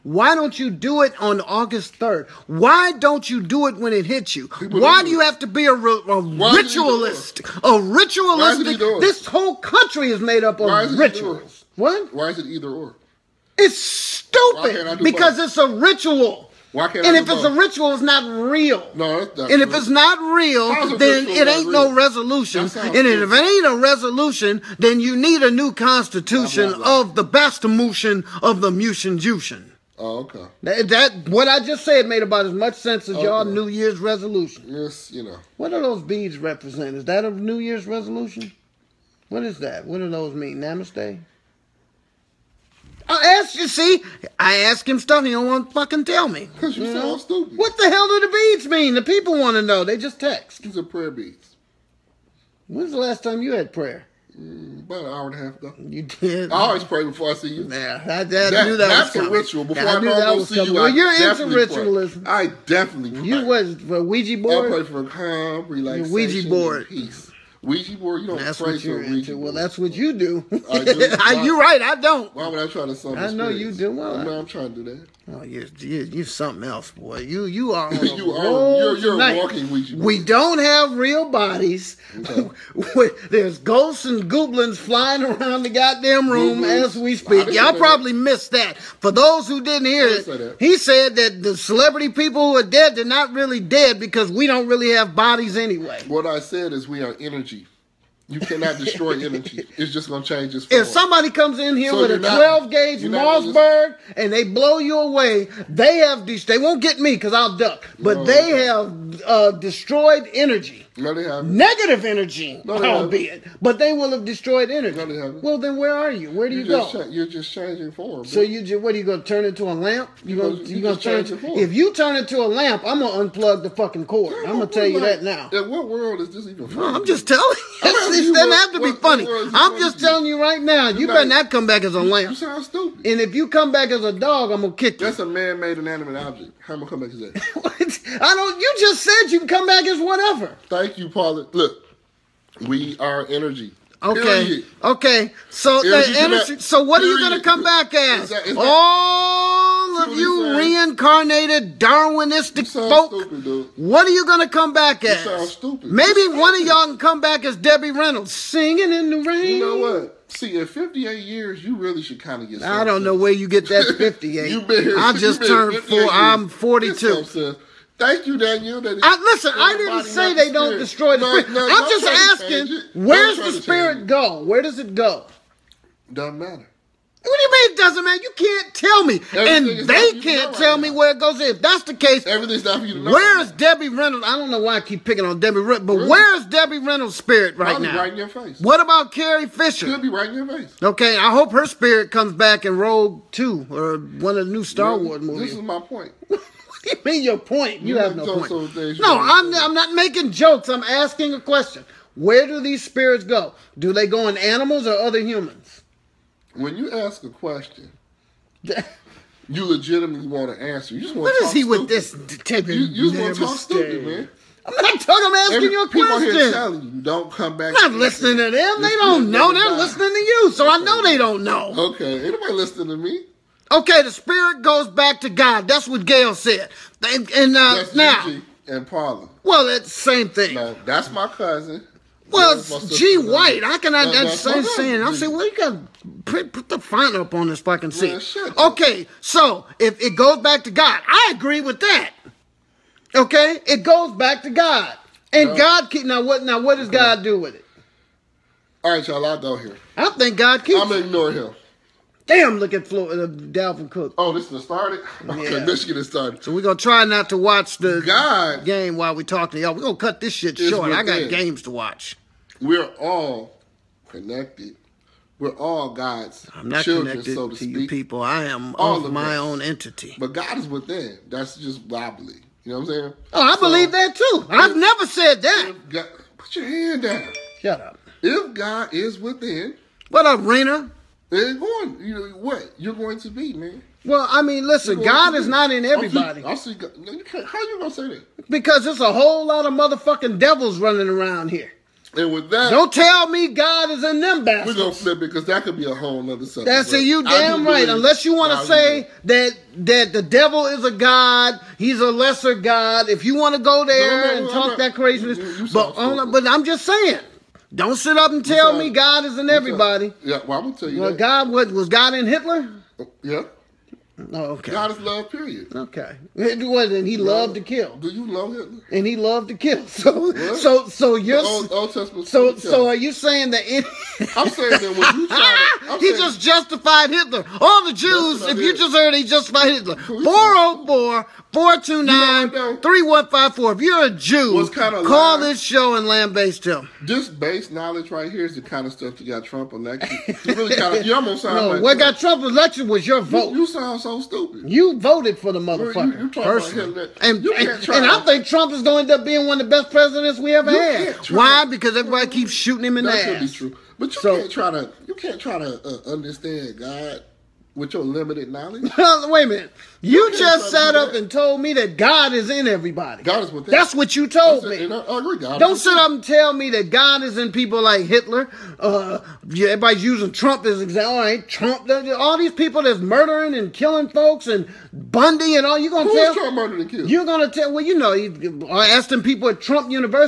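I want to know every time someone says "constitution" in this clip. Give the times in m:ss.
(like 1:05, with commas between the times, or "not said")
0:25.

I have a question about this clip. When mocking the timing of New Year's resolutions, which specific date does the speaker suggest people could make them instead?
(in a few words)
August 3rd.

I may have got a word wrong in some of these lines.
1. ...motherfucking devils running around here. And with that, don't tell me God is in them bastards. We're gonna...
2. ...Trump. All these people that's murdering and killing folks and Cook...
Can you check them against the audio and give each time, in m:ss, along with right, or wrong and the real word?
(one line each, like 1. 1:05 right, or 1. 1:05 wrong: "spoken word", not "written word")
1. 4:49 right
2. 6:11 wrong: "Bundy", not "Cook".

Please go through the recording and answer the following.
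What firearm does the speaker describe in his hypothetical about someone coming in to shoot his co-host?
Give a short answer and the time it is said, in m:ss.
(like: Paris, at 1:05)
twelve gauge Mossberg, at 1:42.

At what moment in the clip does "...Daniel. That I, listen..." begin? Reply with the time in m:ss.
2:48.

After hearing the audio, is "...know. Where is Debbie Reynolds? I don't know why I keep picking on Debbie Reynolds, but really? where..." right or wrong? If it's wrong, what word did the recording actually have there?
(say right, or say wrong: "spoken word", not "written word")
right.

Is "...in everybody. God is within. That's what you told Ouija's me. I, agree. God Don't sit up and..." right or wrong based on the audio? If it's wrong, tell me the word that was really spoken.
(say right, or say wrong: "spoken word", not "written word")
wrong: "That", not "Ouija".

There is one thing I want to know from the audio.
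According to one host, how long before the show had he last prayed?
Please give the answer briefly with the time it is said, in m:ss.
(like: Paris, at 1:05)
an hour and a half, at 0:54.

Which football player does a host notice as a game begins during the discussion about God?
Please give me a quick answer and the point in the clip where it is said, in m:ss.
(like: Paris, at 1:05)
Dalvin Cook, at 4:13.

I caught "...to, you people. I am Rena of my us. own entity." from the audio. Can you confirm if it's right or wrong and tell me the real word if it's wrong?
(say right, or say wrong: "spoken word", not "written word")
wrong: "All", not "Rena".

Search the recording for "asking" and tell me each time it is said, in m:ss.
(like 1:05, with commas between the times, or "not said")
2:52, 3:20, 3:35.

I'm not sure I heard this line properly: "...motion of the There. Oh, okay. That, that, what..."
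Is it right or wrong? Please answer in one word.
wrong.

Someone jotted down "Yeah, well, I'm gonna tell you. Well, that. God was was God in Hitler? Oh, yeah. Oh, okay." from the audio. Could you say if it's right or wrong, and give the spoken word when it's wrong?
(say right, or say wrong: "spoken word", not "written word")
right.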